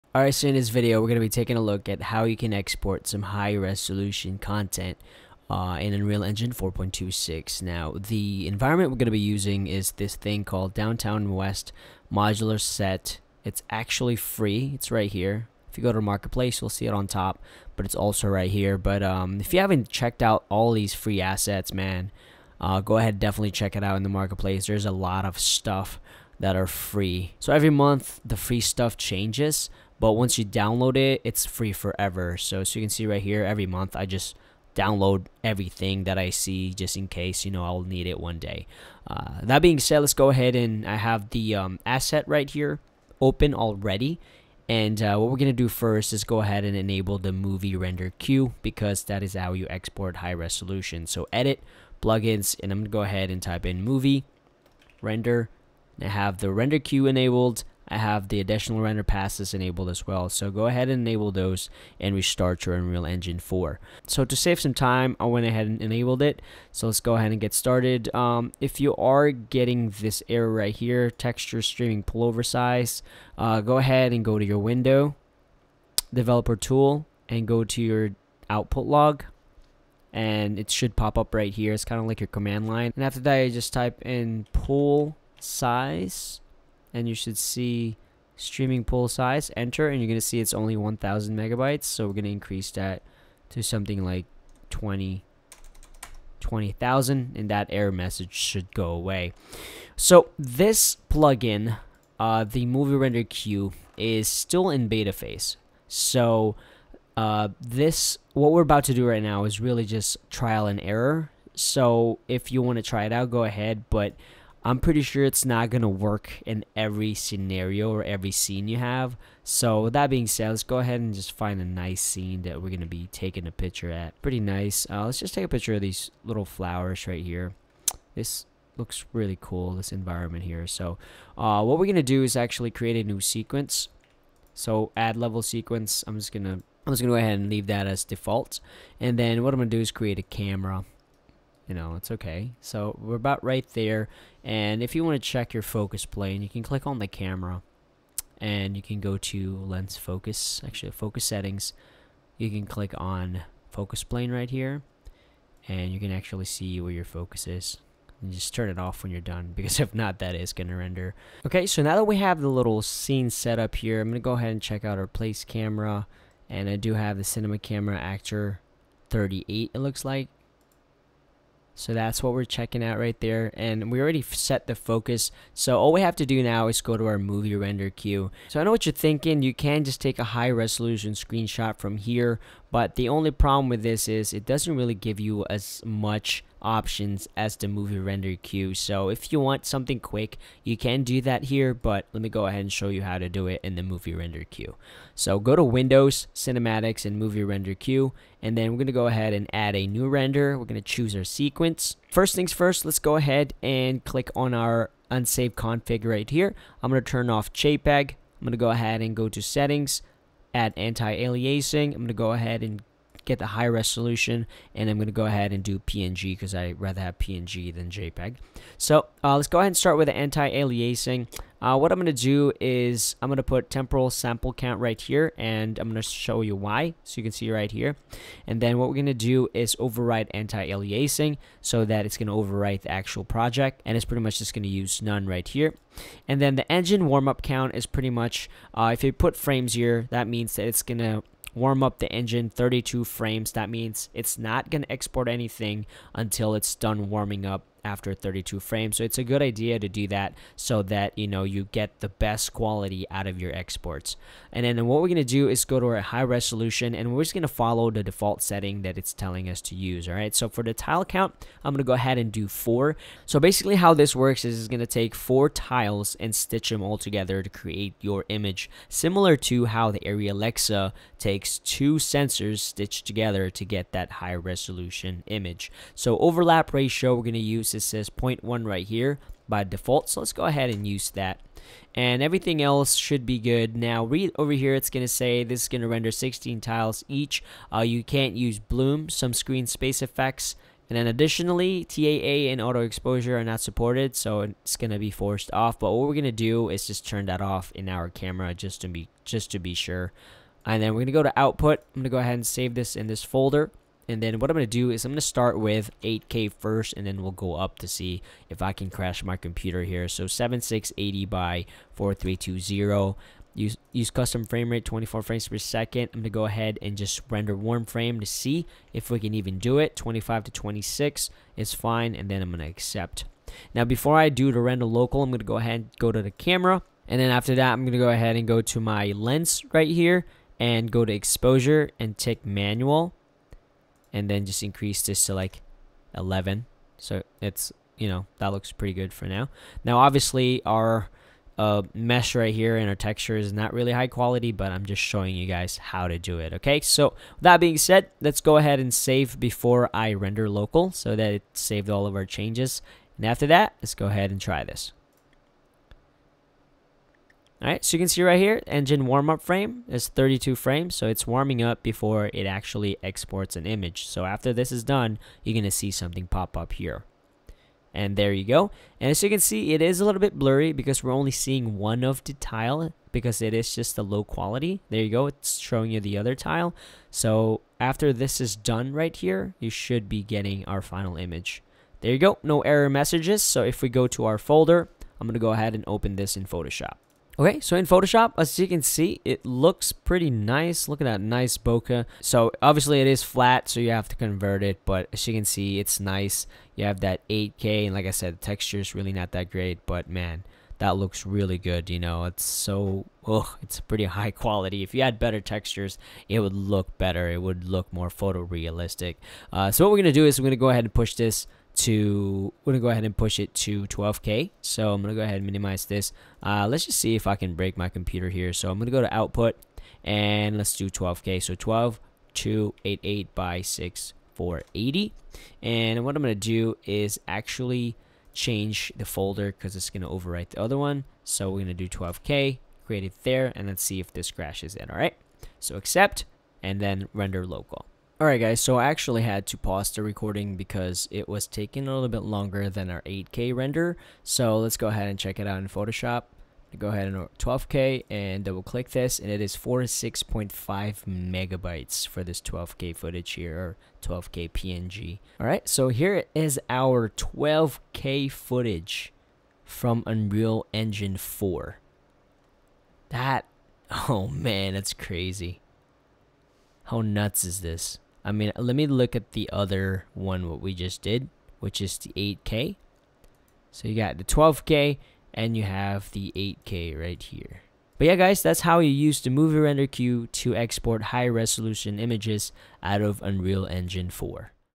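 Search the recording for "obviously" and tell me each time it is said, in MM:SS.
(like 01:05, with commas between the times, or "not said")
05:39, 06:32.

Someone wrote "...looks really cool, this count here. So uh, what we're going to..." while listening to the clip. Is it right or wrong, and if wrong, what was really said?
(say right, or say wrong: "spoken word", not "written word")
wrong: "environment", not "count".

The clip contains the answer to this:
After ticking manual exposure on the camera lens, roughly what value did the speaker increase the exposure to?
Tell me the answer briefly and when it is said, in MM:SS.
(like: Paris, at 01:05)
11, at 05:36.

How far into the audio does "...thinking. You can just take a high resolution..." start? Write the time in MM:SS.
02:58.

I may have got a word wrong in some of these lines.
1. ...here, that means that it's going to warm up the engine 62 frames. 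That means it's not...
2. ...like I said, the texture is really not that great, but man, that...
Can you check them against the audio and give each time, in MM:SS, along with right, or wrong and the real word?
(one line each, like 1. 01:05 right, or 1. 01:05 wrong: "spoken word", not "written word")
1. 03:59 wrong: "32", not "62"
2. 06:37 right.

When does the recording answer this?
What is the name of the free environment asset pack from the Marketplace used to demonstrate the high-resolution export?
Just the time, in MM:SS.
00:10.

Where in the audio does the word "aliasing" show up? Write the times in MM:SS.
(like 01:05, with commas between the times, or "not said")
03:30, 03:40, 03:50.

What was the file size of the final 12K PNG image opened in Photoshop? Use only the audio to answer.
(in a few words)
46.5 megabytes.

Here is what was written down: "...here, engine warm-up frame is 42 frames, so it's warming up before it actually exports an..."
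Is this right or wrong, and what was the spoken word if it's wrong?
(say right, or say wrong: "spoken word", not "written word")
wrong: "32", not "42".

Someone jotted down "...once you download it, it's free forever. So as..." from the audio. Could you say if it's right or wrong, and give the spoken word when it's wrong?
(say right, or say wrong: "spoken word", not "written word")
right.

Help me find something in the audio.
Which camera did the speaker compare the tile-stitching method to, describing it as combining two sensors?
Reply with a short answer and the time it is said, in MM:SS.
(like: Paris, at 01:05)
Arri Alexa, at 04:30.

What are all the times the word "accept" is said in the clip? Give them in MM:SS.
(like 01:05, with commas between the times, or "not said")
05:22, 07:15.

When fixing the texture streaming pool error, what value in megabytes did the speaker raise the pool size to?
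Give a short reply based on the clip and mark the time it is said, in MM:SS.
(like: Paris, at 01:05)
20,000, at 01:36.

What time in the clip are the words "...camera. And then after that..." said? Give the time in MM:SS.
05:26.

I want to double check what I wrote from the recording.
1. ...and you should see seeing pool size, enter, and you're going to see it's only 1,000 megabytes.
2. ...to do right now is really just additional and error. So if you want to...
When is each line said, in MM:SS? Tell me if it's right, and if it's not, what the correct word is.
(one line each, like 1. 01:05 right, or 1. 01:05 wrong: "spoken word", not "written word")
1. 01:26 wrong: "streaming", not "seeing"
2. 01:48 wrong: "trial", not "additional".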